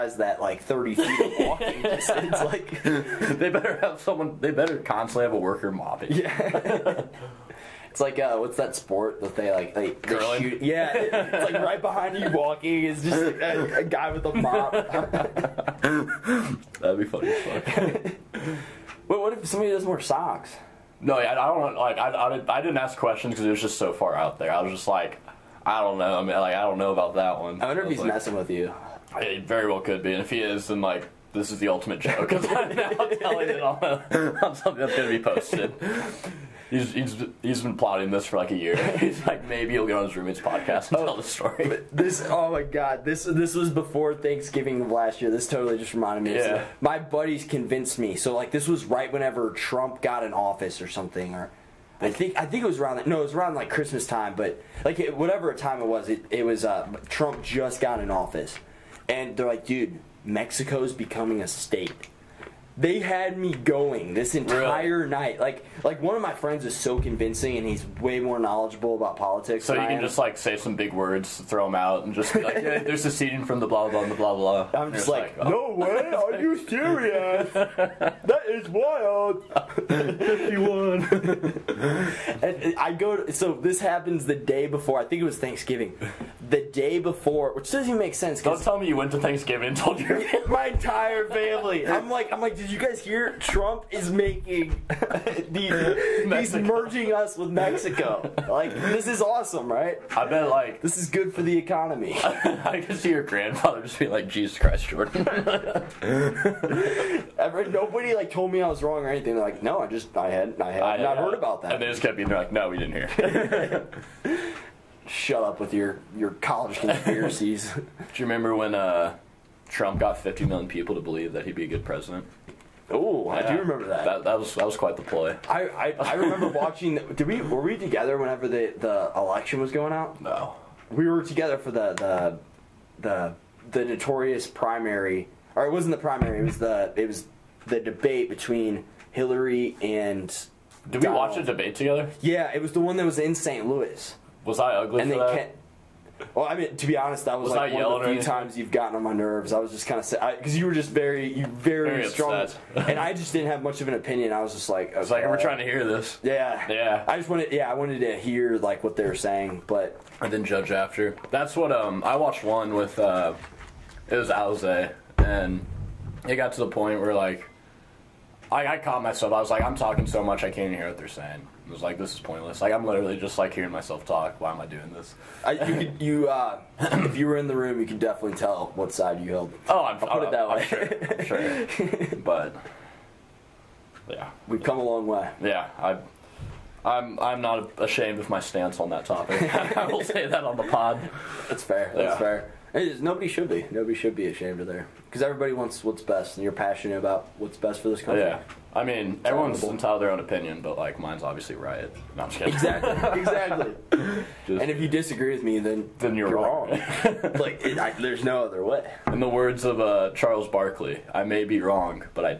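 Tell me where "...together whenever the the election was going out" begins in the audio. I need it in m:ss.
2:07.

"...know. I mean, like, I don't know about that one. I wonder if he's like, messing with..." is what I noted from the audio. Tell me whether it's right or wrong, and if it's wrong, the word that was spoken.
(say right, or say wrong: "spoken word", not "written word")
right.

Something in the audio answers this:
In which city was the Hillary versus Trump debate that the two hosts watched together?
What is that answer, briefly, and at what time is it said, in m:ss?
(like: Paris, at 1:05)
St. Louis, at 2:23.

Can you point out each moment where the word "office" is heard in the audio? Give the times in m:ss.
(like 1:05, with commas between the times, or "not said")
0:50, 0:58.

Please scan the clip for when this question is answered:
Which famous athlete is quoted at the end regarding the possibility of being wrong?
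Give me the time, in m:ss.
3:30.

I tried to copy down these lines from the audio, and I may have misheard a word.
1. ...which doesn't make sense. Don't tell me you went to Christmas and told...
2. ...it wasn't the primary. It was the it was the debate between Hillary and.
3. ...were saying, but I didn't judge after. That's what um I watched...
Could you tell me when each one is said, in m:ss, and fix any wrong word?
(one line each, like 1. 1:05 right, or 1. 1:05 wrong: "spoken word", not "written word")
1. 1:27 wrong: "Thanksgiving", not "Christmas"
2. 2:15 right
3. 2:39 right.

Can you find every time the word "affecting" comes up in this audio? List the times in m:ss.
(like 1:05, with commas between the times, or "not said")
not said.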